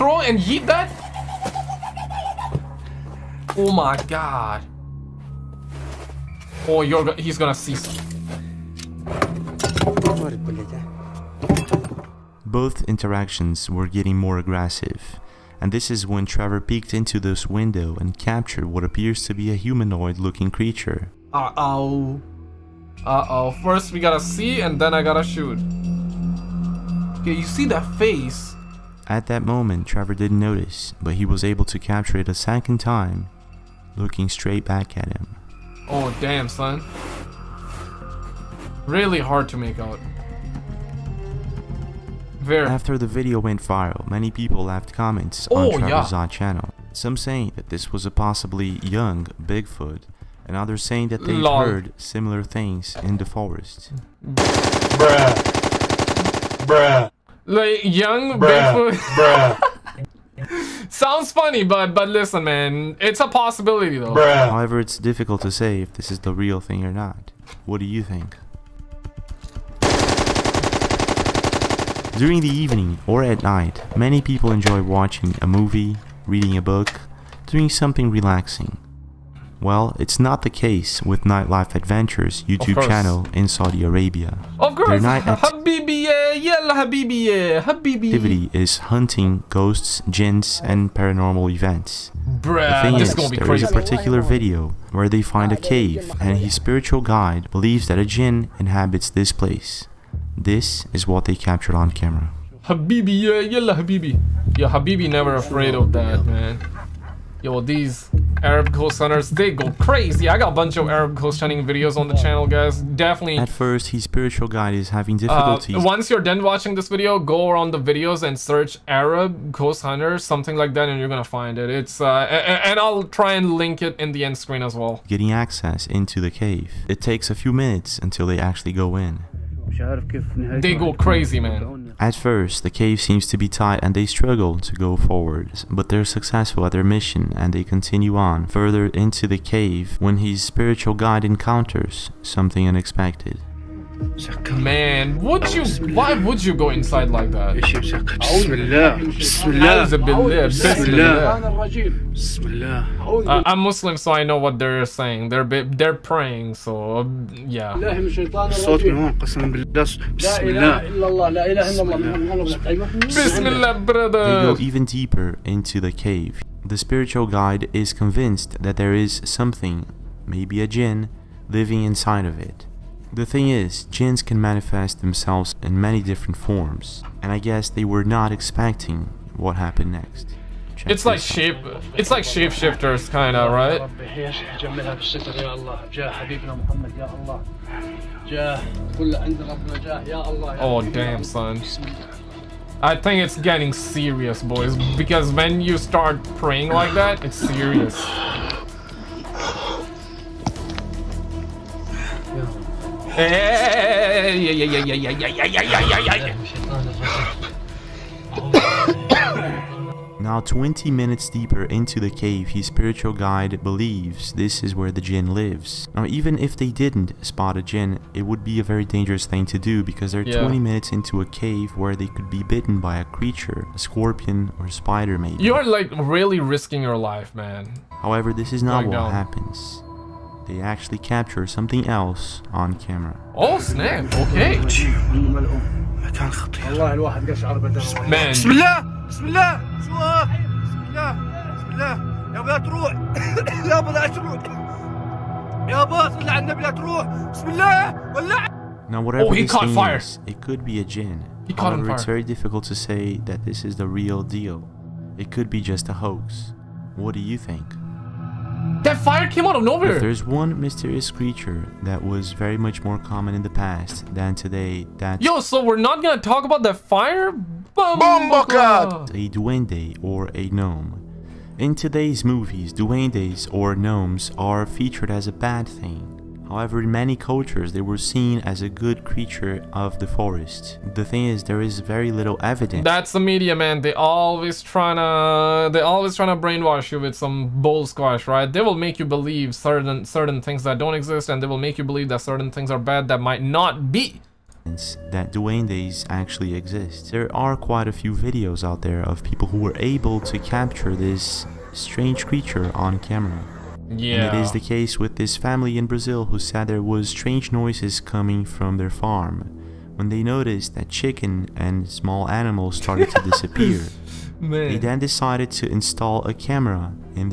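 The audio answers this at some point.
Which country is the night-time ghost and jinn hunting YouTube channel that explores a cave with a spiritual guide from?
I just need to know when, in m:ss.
1:23.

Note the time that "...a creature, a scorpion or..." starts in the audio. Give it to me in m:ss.
3:42.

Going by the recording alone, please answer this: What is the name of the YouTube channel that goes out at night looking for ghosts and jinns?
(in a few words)
Nightlife Adventures.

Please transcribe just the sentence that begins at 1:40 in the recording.
This is what they captured on camera.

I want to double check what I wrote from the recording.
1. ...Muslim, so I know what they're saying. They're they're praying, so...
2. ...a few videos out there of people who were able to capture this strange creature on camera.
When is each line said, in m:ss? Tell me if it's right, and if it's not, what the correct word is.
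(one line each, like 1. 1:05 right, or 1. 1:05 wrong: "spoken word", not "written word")
1. 2:33 right
2. 4:57 right.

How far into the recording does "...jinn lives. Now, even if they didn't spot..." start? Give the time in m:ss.
3:35.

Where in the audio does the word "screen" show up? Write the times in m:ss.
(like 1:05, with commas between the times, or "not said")
2:04.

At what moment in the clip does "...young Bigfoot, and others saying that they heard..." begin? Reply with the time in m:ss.
0:48.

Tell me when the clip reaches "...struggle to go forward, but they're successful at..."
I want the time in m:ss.
2:14.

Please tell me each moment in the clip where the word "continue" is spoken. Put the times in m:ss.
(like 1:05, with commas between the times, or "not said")
2:17.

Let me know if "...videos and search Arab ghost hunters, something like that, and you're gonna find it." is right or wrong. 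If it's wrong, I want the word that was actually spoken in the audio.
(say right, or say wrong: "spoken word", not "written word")
right.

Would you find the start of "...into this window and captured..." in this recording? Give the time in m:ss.
0:16.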